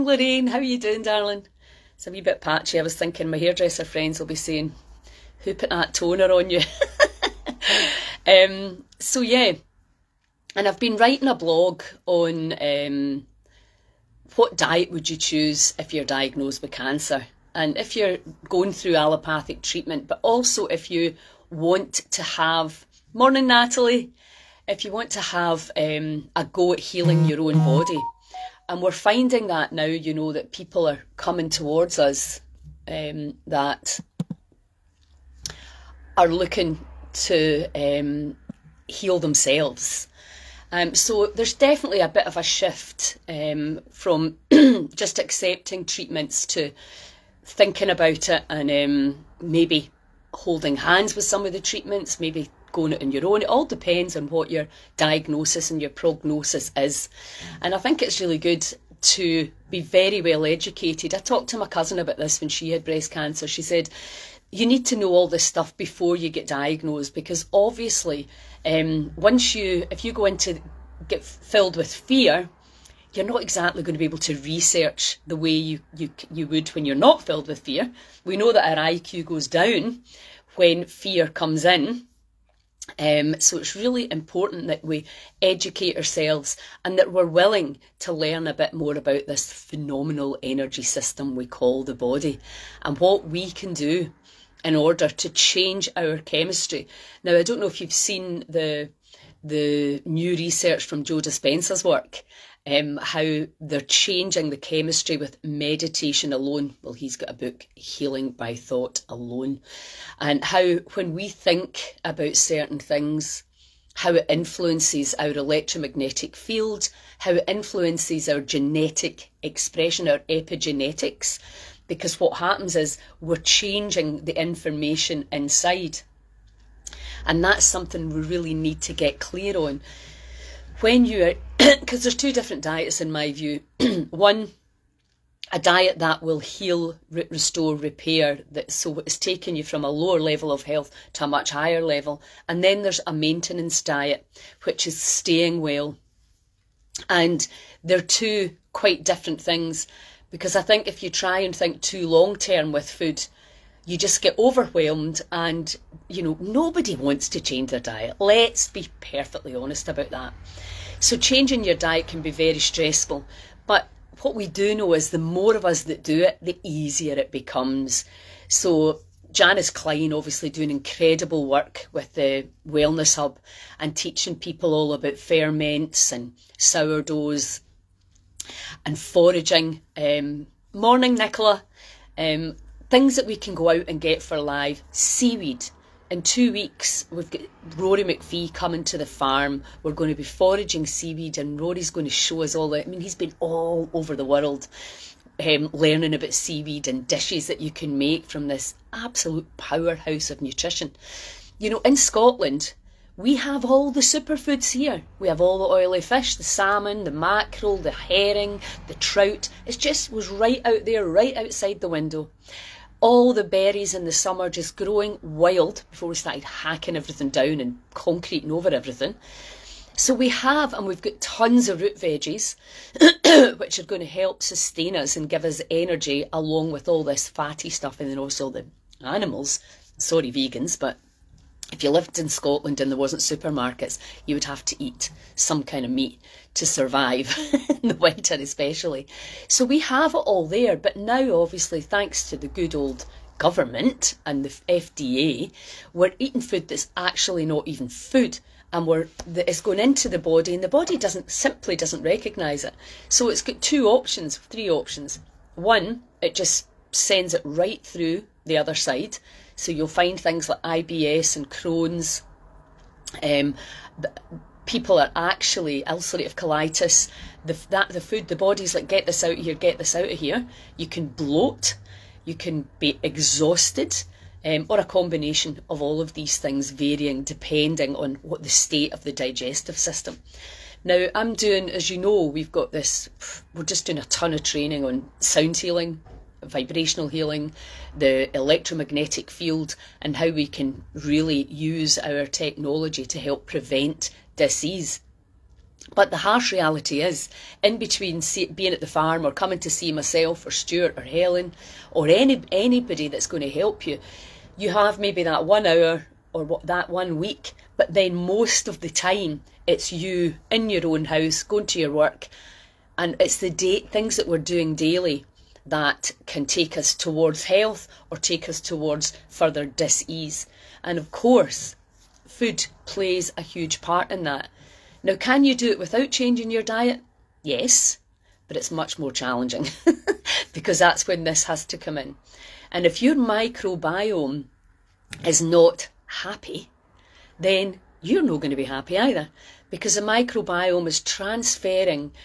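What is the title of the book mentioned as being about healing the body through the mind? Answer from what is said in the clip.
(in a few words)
Healing by Thought Alone.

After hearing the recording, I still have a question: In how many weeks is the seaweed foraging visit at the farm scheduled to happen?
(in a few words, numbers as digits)
2.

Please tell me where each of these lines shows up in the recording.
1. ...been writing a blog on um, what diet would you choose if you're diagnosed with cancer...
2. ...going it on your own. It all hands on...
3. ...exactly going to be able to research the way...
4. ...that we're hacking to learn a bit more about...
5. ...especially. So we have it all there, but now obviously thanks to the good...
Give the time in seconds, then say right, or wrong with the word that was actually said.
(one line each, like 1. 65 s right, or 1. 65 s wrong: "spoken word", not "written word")
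1. 10 s right
2. 52 s wrong: "depends", not "hands"
3. 73 s right
4. 86 s wrong: "willing", not "hacking"
5. 238 s right.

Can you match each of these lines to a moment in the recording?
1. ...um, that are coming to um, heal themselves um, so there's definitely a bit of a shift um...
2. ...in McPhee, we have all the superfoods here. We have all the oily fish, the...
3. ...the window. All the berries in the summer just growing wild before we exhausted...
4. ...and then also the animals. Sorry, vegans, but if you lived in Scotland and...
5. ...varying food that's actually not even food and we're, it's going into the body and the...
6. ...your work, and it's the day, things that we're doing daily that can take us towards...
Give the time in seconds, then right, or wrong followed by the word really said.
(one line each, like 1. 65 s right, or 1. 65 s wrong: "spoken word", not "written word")
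1. 32 s wrong: "looking", not "coming"
2. 201 s wrong: "Scotland", not "McPhee"
3. 211 s wrong: "started", not "exhausted"
4. 227 s right
5. 246 s wrong: "eating", not "varying"
6. 311 s right.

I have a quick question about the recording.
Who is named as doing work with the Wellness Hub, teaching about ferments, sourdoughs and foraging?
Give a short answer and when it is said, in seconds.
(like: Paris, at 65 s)
Janice Klein, at 169 s.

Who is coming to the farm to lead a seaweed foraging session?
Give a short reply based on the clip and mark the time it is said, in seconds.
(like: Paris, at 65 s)
Rory McPhee, at 187 s.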